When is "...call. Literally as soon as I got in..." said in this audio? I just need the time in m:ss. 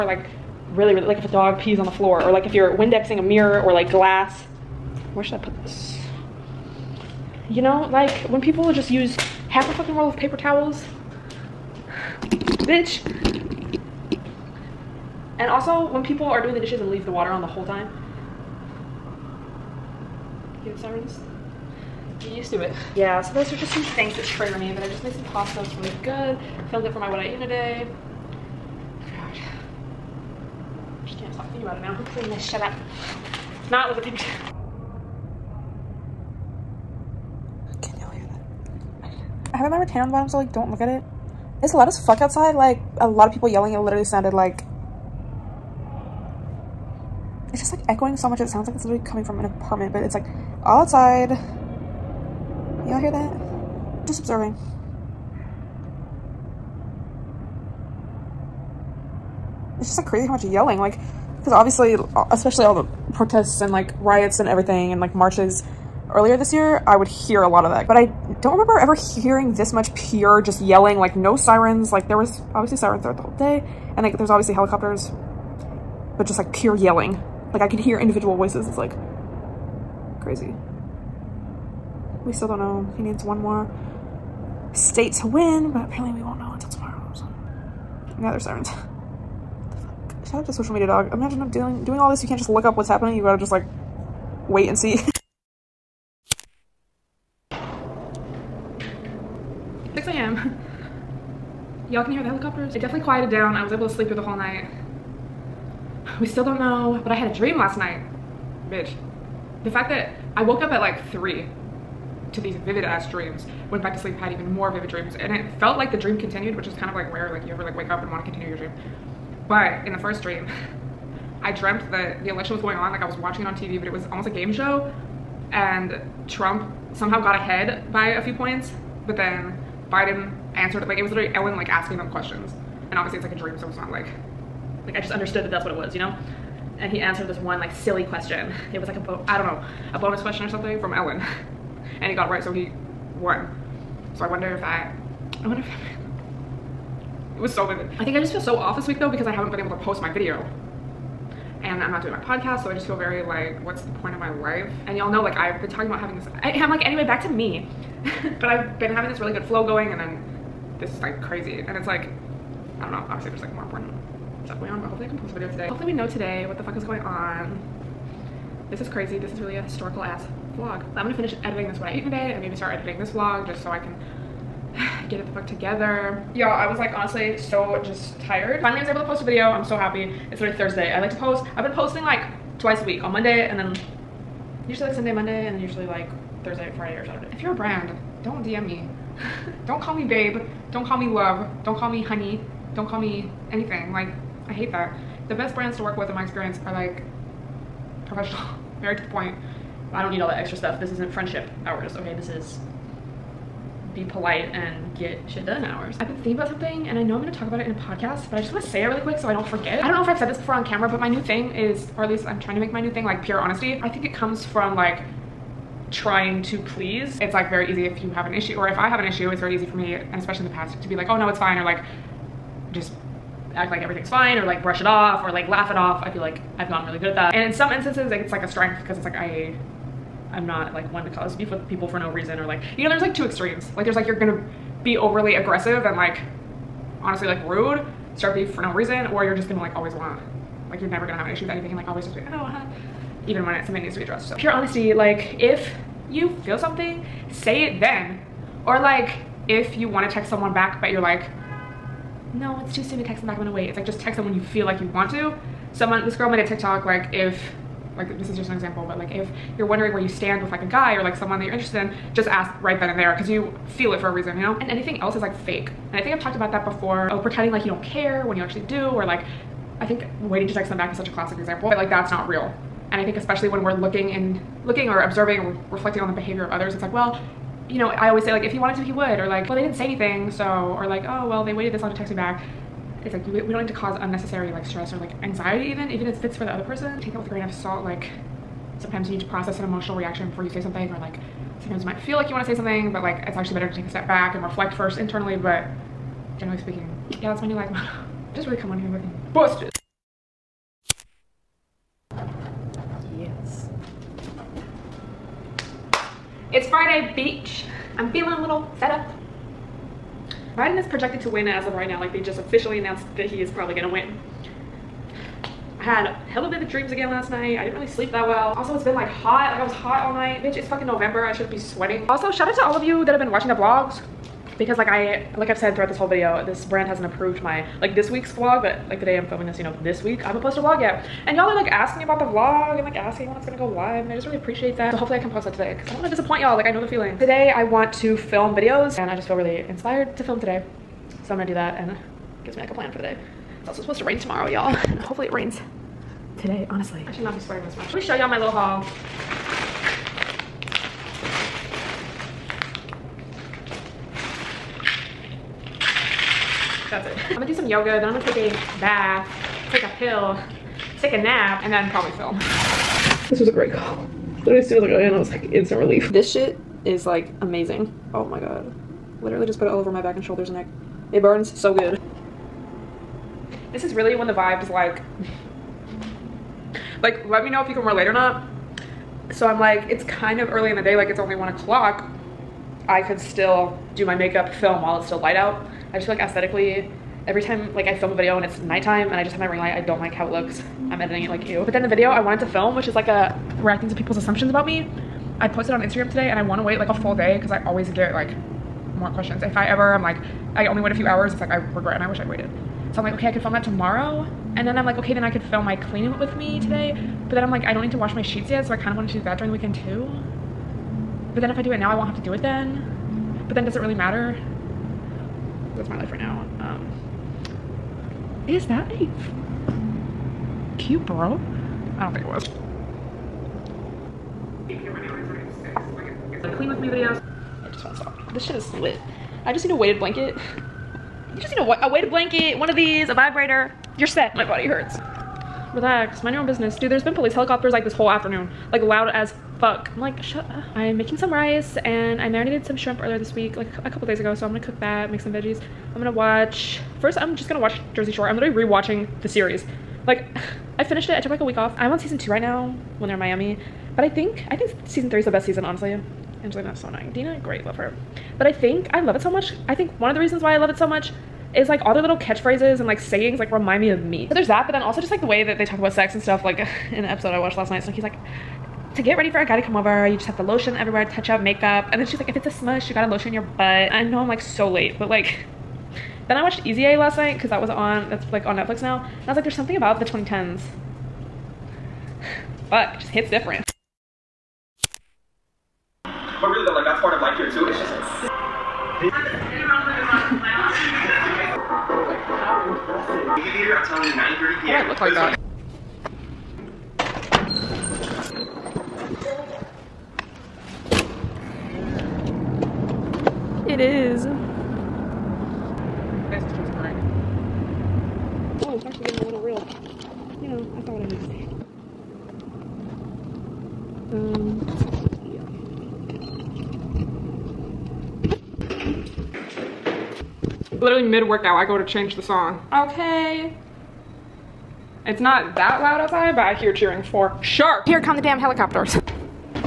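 6:03.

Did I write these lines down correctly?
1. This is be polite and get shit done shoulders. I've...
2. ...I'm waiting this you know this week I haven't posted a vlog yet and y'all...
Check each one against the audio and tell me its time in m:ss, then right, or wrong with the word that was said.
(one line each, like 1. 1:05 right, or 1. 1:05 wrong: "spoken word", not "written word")
1. 3:22 wrong: "hours", not "shoulders"
2. 5:29 wrong: "filming", not "waiting".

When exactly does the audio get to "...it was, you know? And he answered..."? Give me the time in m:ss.
2:15.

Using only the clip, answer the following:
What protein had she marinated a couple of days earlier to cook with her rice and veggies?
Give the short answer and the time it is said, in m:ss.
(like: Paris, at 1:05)
shrimp, at 7:22.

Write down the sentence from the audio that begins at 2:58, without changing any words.
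Finally I was able to post a video.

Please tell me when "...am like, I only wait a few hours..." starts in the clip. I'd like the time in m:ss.
6:39.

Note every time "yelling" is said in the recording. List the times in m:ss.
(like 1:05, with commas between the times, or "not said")
0:43, 1:00, 1:10, 1:16.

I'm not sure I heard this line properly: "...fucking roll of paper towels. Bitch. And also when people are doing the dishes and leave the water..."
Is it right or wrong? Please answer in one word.
right.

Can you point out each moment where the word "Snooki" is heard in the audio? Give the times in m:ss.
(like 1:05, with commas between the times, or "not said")
7:47.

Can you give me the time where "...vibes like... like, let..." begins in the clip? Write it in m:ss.
6:14.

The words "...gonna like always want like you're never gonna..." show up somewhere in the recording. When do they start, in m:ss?
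3:59.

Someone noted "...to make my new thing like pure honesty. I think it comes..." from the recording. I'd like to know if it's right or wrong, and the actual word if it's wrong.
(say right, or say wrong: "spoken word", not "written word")
right.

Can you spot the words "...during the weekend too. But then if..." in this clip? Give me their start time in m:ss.
6:49.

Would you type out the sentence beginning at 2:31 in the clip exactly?
And I'm not doing my podcast, so I just feel very like, what's the point of my life?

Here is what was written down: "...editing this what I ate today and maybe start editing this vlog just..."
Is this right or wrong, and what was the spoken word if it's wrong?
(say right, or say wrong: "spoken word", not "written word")
right.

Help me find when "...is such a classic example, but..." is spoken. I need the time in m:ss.
4:30.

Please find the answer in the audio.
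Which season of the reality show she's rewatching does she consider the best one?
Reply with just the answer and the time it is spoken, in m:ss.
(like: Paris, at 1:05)
season three, at 7:34.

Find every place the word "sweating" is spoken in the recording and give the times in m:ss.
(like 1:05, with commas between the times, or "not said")
5:21, 5:47.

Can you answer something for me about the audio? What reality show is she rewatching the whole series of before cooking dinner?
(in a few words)
Jersey Shore.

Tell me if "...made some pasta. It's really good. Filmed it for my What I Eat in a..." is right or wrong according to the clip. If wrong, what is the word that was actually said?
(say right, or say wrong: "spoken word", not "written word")
right.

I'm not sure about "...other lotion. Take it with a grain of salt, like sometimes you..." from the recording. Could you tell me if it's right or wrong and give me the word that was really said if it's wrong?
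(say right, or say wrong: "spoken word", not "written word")
wrong: "person", not "lotion".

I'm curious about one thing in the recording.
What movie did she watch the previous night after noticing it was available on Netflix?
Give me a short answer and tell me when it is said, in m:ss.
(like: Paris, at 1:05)
Easy A, at 7:56.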